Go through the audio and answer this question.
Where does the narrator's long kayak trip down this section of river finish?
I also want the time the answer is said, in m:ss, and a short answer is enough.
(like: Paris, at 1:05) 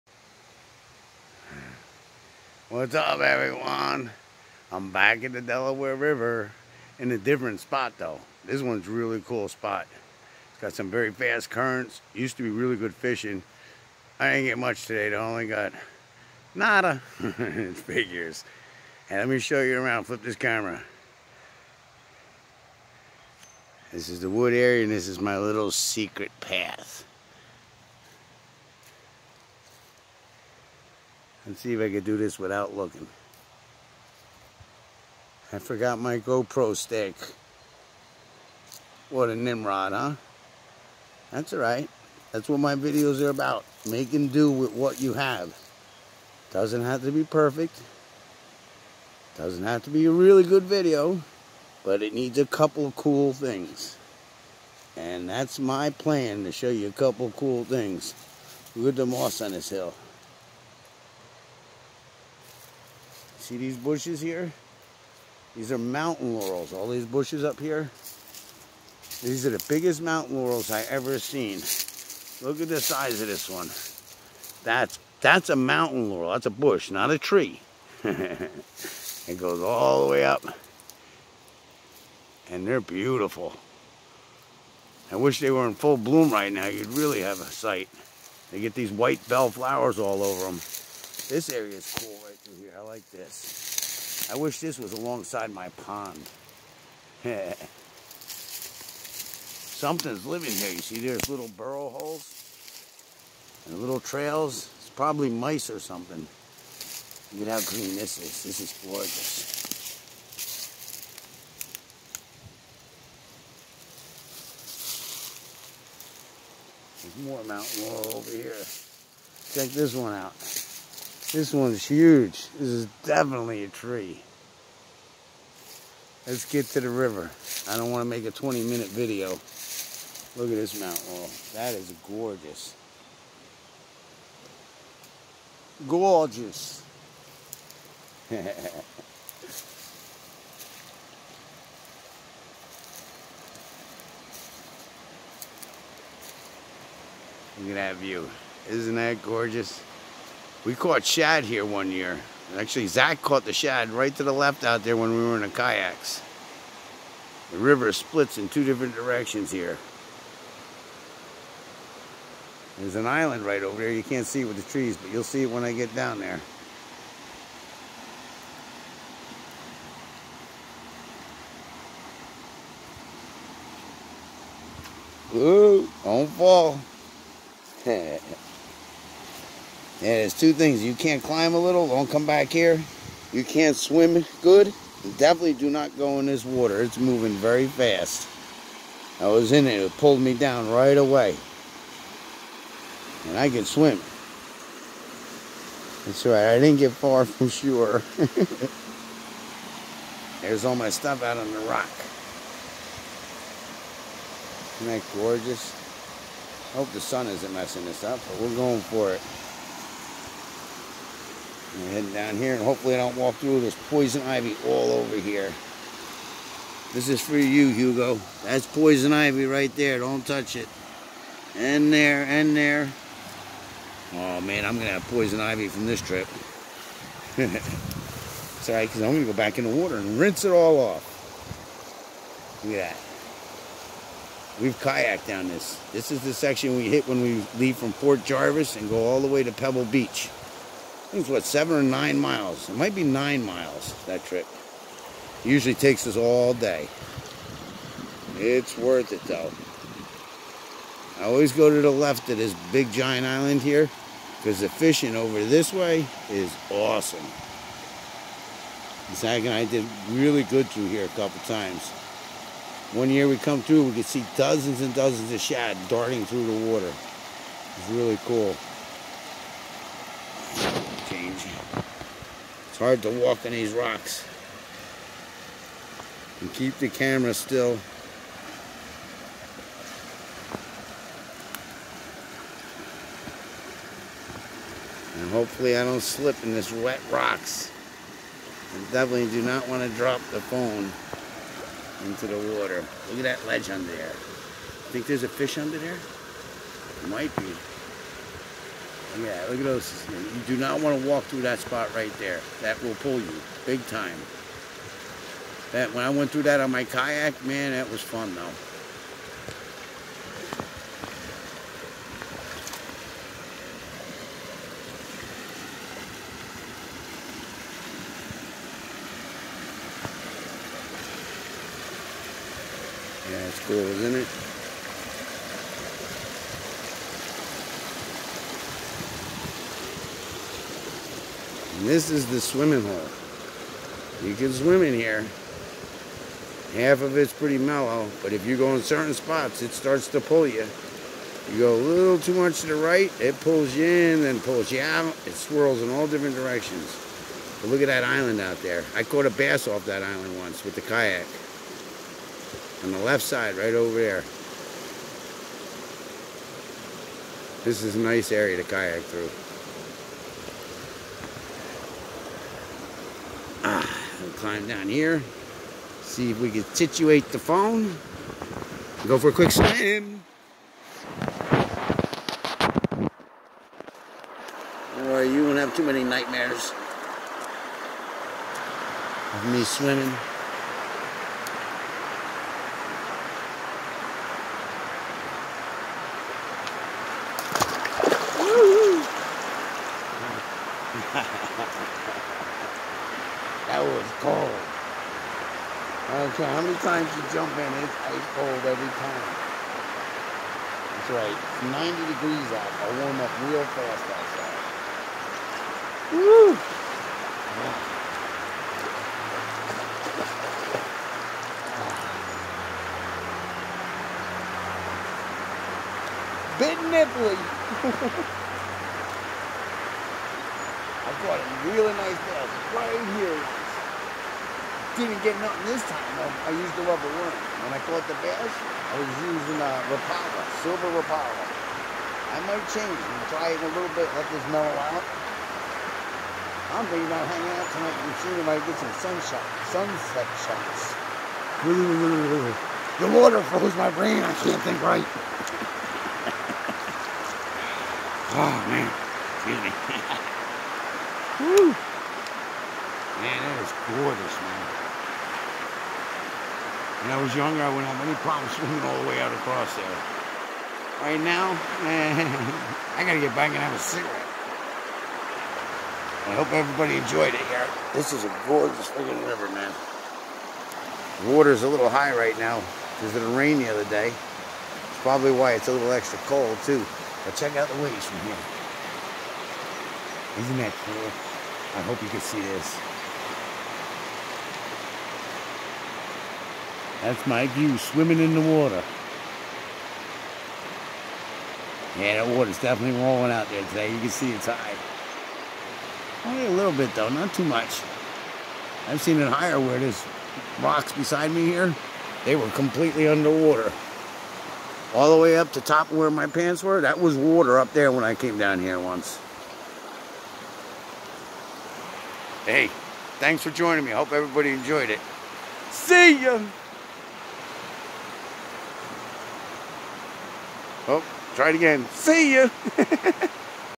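Pebble Beach, at 3:59.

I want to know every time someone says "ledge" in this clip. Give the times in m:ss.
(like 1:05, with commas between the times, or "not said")
4:53.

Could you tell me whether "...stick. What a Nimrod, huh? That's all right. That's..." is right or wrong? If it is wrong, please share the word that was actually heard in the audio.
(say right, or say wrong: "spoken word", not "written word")
right.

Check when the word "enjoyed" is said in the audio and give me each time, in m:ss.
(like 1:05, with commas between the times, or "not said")
7:46, 8:34.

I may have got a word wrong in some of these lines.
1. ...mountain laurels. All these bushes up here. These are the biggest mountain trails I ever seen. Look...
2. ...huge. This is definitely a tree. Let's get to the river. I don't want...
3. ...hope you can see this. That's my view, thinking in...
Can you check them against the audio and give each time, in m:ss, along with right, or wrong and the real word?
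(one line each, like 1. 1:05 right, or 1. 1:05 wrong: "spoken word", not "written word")
1. 1:05 wrong: "laurels", not "trails"
2. 2:01 right
3. 8:01 wrong: "swimming", not "thinking".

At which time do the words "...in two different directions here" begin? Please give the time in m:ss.
2:38.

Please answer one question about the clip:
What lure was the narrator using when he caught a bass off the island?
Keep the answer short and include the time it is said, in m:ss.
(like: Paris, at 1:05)
silver Rapala, at 7:10.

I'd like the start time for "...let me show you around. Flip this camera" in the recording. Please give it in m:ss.
0:19.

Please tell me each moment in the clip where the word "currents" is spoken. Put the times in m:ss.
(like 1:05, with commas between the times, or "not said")
0:11.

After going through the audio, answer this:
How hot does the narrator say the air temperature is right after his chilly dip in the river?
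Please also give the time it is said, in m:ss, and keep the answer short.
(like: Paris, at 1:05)
90 degrees, at 6:41.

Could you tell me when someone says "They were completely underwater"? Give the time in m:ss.
8:22.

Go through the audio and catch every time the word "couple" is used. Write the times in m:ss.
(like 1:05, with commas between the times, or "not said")
0:52, 0:56, 4:21.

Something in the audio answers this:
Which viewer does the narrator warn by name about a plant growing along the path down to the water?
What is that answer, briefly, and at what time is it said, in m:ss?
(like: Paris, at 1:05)
Hugo, at 3:37.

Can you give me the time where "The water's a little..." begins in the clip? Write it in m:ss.
7:51.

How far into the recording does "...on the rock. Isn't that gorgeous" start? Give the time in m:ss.
3:21.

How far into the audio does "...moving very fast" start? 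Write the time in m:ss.
3:06.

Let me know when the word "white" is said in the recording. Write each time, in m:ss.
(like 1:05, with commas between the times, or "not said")
1:28.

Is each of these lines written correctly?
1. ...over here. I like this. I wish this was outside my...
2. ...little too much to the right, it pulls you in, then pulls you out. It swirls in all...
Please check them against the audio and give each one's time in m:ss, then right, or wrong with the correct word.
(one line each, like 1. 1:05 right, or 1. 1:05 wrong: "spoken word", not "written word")
1. 1:32 wrong: "alongside", not "outside"
2. 5:41 right.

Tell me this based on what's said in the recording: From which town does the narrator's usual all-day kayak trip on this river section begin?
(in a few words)
Port Jervis.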